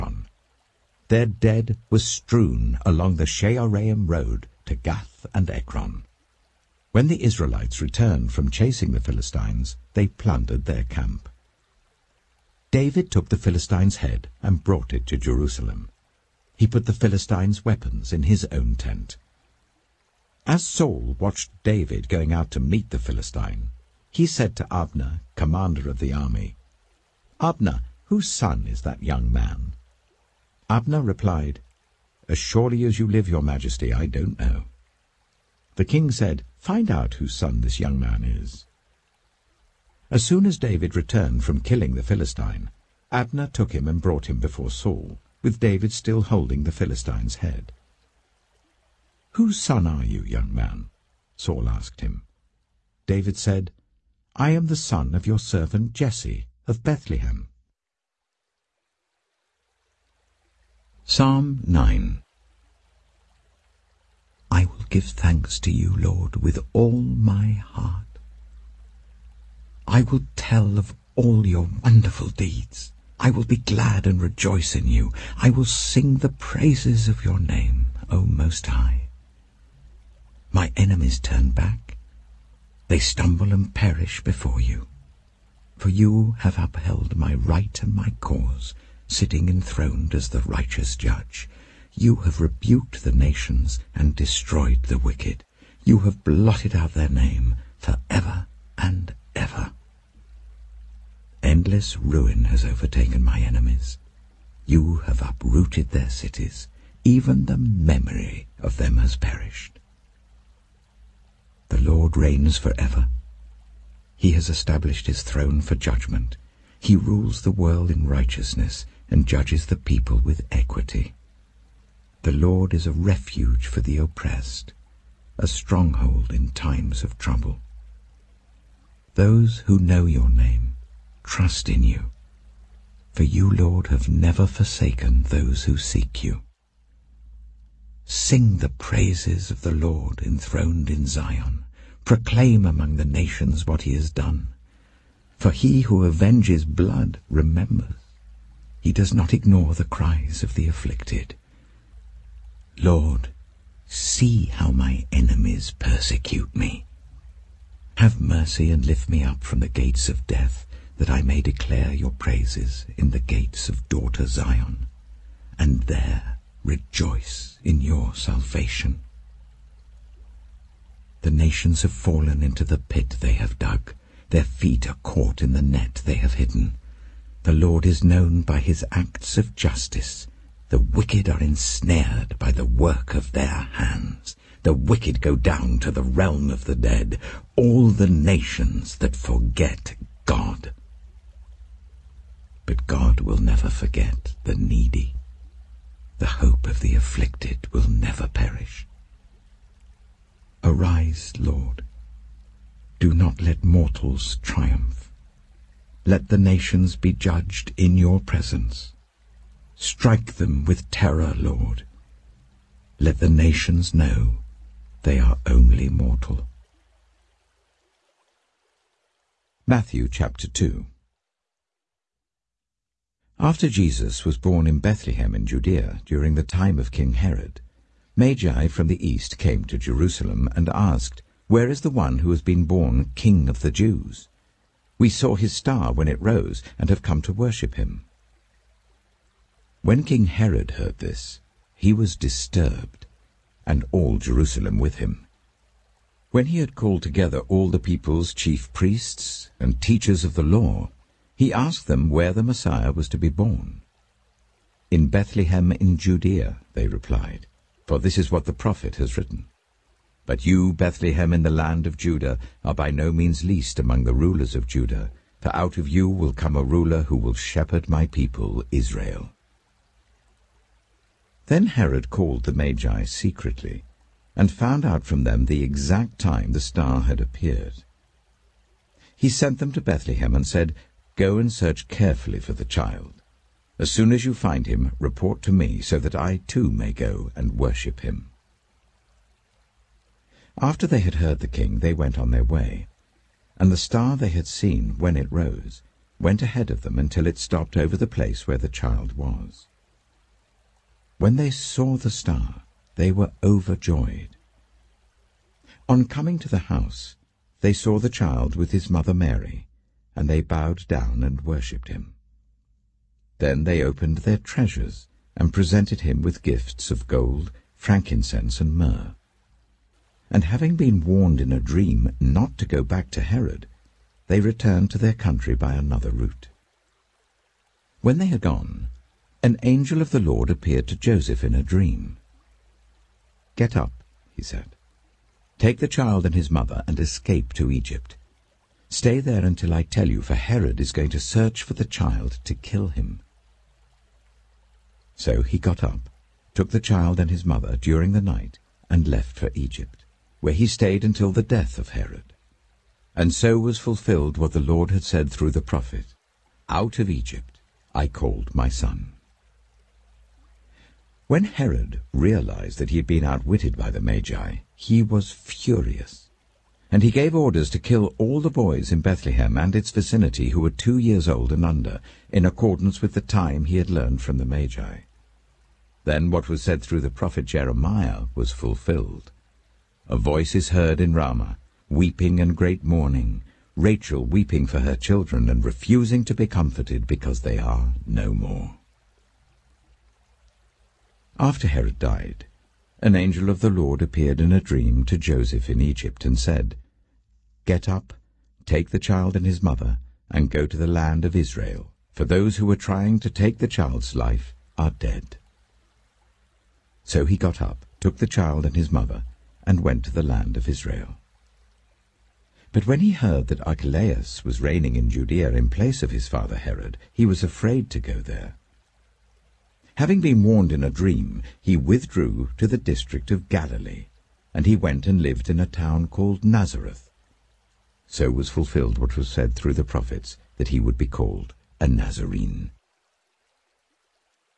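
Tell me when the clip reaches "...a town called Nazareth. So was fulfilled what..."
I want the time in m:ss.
7:05.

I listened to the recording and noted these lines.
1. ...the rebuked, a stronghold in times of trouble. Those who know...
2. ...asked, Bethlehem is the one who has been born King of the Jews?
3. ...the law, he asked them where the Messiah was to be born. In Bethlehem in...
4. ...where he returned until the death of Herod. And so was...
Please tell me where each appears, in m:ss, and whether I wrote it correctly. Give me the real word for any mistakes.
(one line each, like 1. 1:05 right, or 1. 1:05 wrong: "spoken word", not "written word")
1. 2:03 wrong: "oppressed", not "rebuked"
2. 3:50 wrong: "Where", not "Bethlehem"
3. 4:10 right
4. 5:50 wrong: "stayed", not "returned".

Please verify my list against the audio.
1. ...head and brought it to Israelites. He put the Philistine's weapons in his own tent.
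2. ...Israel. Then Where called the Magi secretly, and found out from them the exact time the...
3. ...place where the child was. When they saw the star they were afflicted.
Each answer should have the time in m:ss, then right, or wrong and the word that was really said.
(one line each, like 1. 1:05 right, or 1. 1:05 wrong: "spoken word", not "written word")
1. 0:14 wrong: "Jerusalem", not "Israelites"
2. 4:28 wrong: "Herod", not "Where"
3. 4:58 wrong: "overjoyed", not "afflicted".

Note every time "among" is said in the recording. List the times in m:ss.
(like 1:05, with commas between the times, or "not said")
2:22, 4:23.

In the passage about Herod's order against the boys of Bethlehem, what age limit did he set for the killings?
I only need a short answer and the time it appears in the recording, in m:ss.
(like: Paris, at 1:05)
2 years old and under, at 6:10.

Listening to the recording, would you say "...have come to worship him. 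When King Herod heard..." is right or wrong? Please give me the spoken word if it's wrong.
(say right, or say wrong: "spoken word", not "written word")
right.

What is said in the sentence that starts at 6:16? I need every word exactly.
Then what was said through the prophet Jeremiah was fulfilled.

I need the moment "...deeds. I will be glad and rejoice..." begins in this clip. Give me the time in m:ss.
1:12.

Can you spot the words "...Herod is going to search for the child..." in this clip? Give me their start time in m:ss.
5:40.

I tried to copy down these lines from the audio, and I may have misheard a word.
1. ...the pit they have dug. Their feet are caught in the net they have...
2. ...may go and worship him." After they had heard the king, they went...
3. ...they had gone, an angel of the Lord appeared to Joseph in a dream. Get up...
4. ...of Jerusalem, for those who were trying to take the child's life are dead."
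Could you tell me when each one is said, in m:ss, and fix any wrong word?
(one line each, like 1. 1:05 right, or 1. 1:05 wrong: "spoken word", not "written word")
1. 2:52 right
2. 4:46 right
3. 5:28 right
4. 6:41 wrong: "Israel", not "Jerusalem".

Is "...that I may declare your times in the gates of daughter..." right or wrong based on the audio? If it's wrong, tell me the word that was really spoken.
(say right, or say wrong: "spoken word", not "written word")
wrong: "praises", not "times".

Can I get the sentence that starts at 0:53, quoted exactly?
David said, I am the son of your servant Jesse of Bethlehem.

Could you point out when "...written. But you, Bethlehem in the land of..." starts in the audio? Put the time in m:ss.
4:19.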